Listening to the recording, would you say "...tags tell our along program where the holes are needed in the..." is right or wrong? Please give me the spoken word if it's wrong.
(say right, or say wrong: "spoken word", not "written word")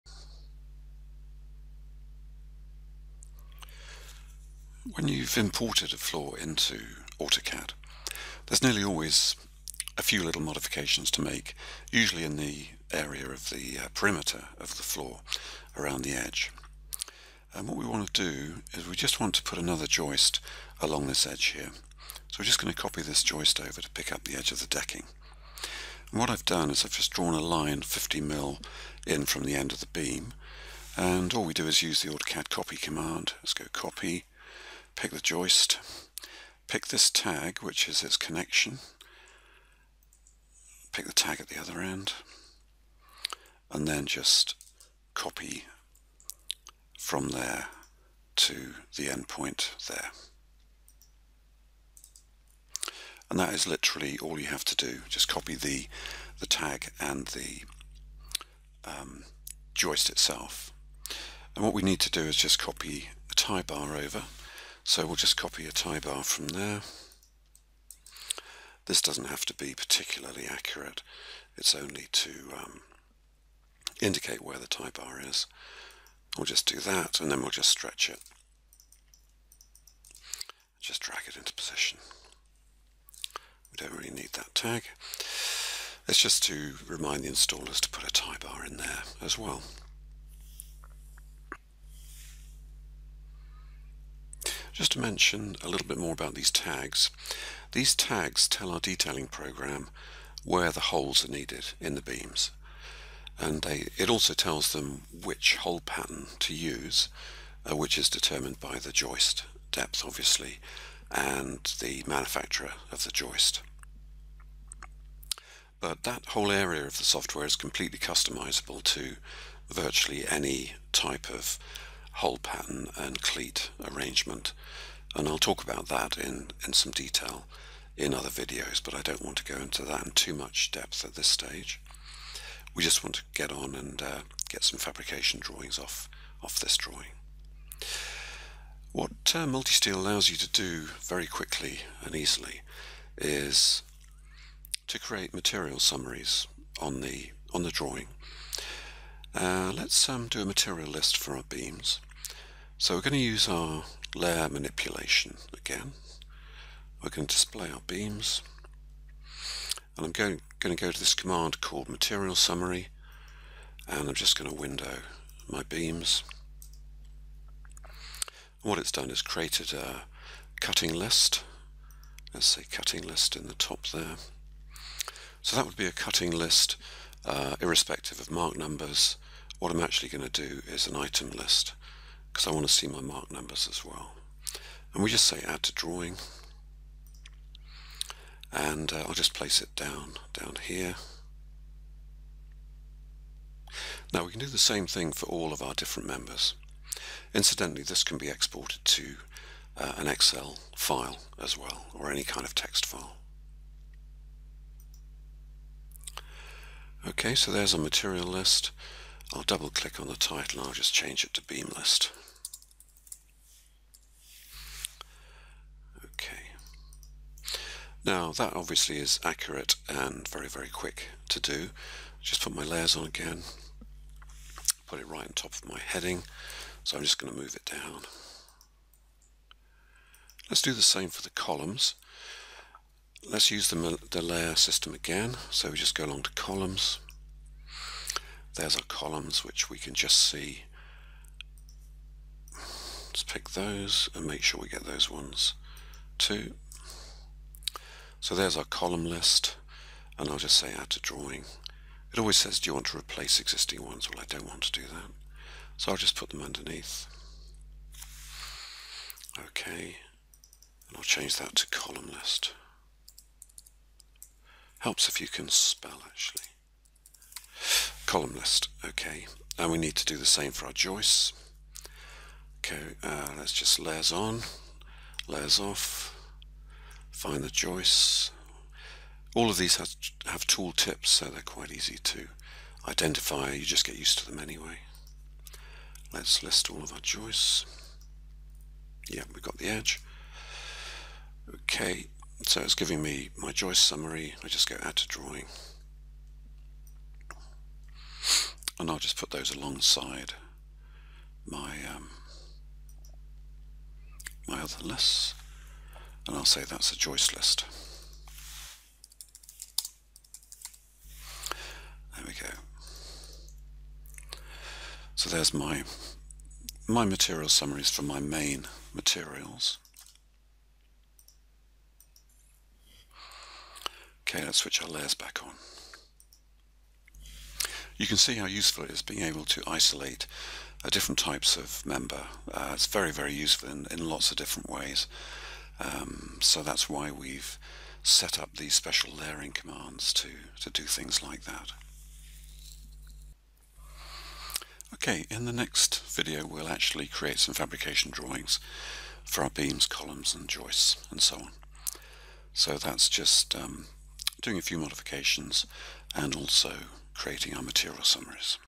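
wrong: "detailing", not "along".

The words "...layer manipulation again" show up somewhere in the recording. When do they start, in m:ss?
2:34.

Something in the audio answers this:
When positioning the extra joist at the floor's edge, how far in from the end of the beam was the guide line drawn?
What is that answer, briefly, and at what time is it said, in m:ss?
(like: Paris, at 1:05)
50 mil, at 0:27.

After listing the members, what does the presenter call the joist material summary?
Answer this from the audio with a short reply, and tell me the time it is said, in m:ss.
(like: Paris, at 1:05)
joist list, at 5:06.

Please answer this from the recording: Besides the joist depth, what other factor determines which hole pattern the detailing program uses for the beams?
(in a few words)
manufacturer of the joist.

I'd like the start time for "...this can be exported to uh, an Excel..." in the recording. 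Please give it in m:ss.
3:17.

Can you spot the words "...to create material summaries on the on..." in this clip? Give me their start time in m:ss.
2:24.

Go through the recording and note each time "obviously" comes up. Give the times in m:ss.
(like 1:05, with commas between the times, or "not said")
1:50, 3:38.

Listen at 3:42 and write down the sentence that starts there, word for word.
Just put my layers on again, put it right on top of my heading, so I'm just going to move it down.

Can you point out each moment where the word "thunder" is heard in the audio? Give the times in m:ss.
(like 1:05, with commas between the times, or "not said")
not said.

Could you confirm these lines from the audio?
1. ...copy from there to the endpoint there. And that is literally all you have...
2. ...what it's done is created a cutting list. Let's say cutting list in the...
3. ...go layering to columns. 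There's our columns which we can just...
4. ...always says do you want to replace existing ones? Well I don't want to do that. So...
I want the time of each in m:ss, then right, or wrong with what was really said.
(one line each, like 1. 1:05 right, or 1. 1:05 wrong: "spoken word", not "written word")
1. 0:45 right
2. 2:48 right
3. 3:55 wrong: "along", not "layering"
4. 4:12 right.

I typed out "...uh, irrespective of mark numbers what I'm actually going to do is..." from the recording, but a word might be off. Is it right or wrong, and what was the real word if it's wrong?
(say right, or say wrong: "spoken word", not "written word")
right.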